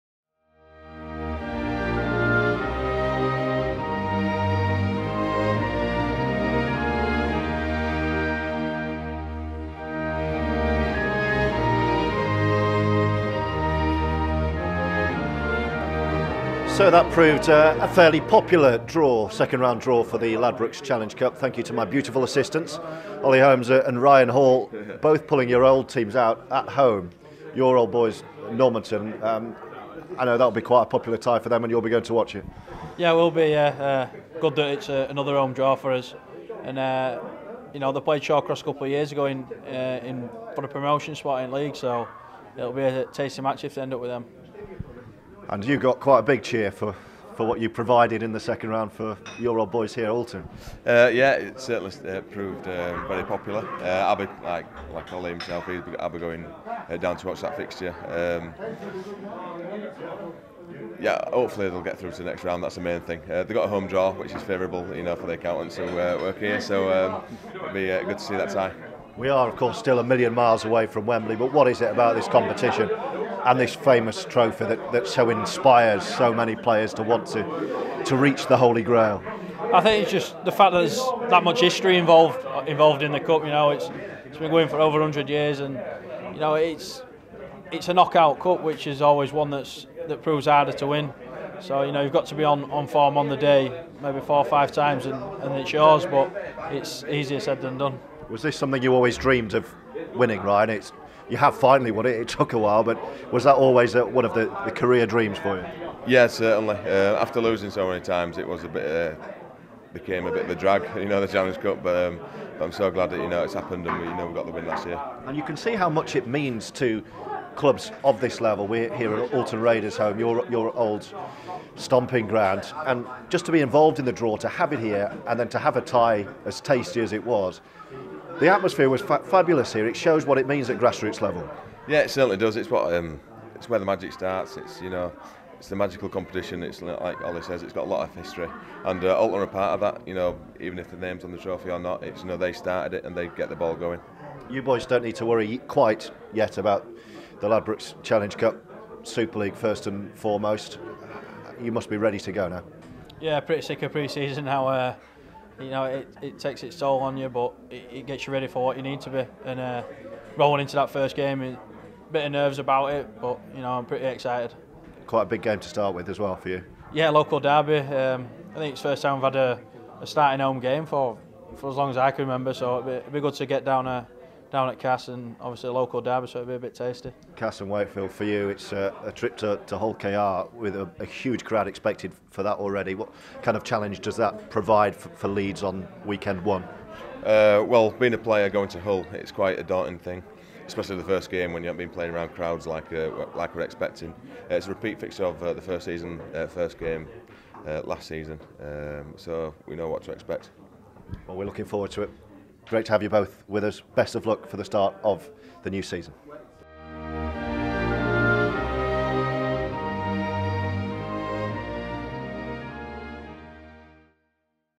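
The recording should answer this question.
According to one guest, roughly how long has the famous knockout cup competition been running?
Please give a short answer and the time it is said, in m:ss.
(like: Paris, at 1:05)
Over 100 years, at 1:24.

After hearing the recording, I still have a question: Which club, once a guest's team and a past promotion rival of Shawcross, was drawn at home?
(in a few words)
Normanton.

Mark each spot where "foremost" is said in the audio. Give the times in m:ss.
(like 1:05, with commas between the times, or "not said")
2:30.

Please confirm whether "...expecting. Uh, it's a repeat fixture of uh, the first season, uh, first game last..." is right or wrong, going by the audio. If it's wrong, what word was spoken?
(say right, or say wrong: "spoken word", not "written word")
right.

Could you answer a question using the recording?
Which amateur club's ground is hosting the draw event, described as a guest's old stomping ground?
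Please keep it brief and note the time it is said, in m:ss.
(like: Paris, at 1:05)
Oulton Raiders, at 1:59.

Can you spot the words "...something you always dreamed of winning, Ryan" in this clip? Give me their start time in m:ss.
1:38.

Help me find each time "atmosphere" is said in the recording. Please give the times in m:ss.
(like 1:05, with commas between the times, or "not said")
2:08.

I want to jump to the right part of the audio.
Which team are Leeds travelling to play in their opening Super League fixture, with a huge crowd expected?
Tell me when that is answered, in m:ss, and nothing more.
2:59.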